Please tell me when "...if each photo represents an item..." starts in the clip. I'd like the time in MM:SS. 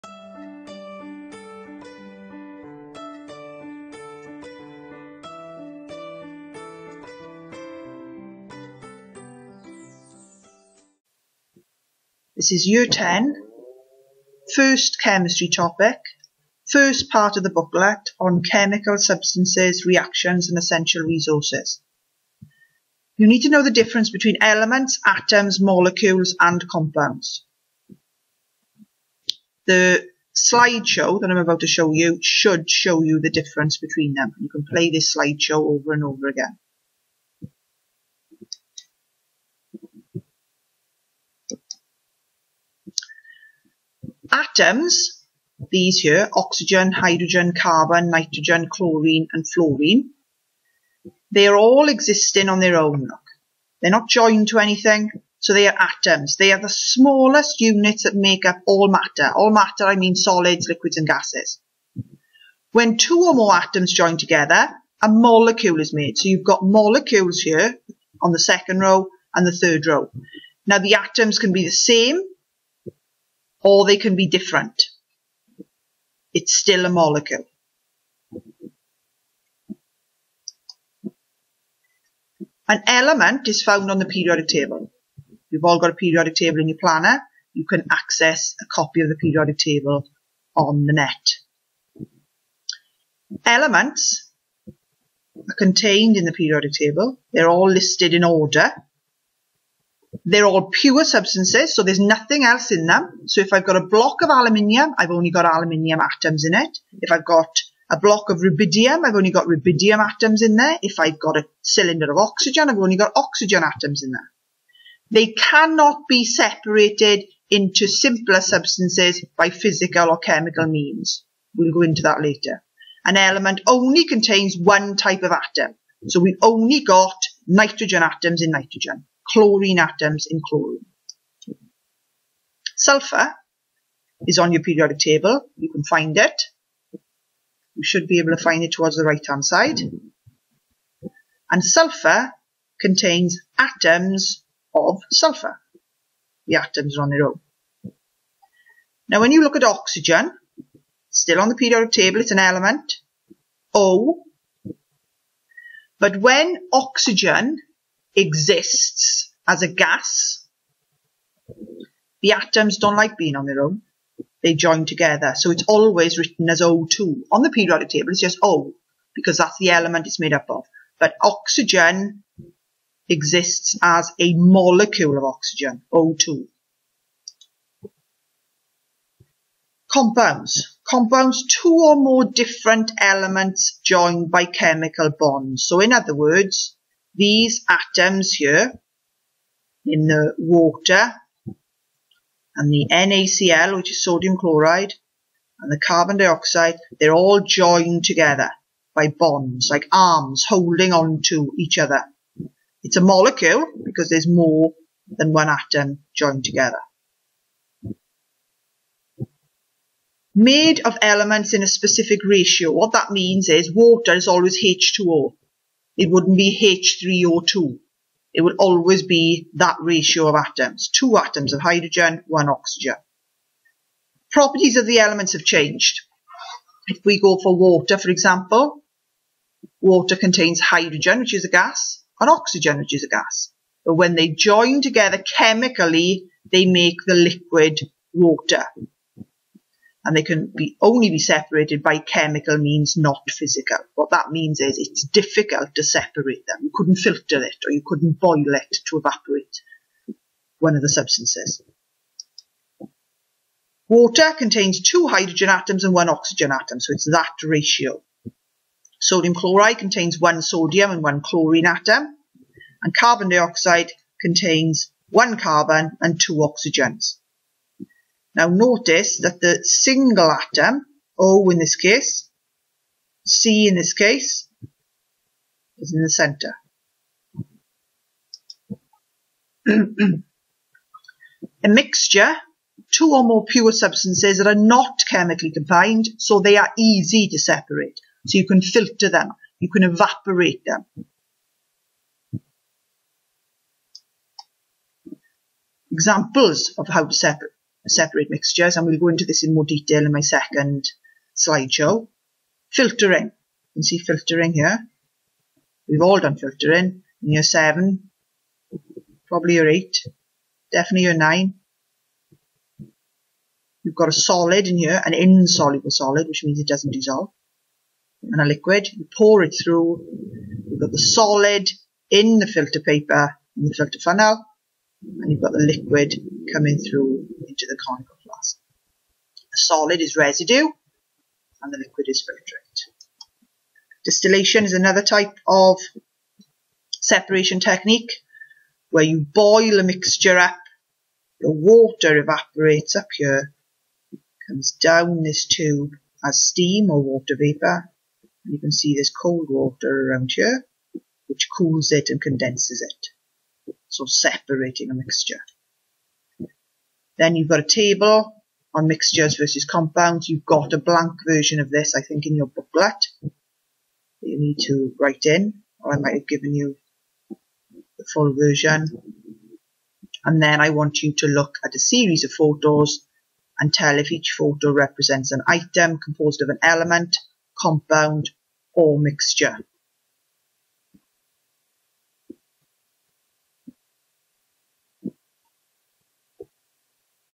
06:13.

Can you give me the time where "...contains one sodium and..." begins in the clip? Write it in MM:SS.
04:19.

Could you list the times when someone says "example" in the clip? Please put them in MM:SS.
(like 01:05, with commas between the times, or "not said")
03:48, 04:55.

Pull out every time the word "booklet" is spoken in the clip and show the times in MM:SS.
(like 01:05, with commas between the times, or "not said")
00:17, 06:02.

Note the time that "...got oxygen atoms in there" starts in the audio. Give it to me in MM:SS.
01:52.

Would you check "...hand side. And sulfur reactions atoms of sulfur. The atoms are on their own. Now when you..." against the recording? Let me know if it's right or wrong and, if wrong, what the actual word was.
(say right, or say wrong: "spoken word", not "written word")
wrong: "contains", not "reactions".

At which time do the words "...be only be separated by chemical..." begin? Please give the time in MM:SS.
04:00.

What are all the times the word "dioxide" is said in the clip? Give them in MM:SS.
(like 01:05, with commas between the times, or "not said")
03:16, 04:23.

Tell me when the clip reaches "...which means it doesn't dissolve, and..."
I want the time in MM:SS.
05:16.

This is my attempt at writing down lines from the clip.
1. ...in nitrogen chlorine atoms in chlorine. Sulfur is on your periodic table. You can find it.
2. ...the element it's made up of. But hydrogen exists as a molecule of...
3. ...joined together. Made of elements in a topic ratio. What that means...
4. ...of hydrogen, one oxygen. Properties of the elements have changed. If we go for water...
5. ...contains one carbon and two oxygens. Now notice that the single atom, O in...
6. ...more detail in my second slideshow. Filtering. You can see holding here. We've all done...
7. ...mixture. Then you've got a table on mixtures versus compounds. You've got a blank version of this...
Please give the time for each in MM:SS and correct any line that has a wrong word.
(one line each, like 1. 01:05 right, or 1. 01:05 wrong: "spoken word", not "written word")
1. 02:08 right
2. 02:49 wrong: "oxygen", not "hydrogen"
3. 03:26 wrong: "specific", not "topic"
4. 03:41 right
5. 04:24 right
6. 04:59 wrong: "filtering", not "holding"
7. 05:54 right.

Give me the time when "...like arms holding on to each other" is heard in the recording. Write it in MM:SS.
03:19.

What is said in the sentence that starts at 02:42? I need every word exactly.
The atoms don't like being on their own.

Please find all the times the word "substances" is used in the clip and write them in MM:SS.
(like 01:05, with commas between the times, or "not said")
00:18, 01:41, 01:58, 04:10, 04:43.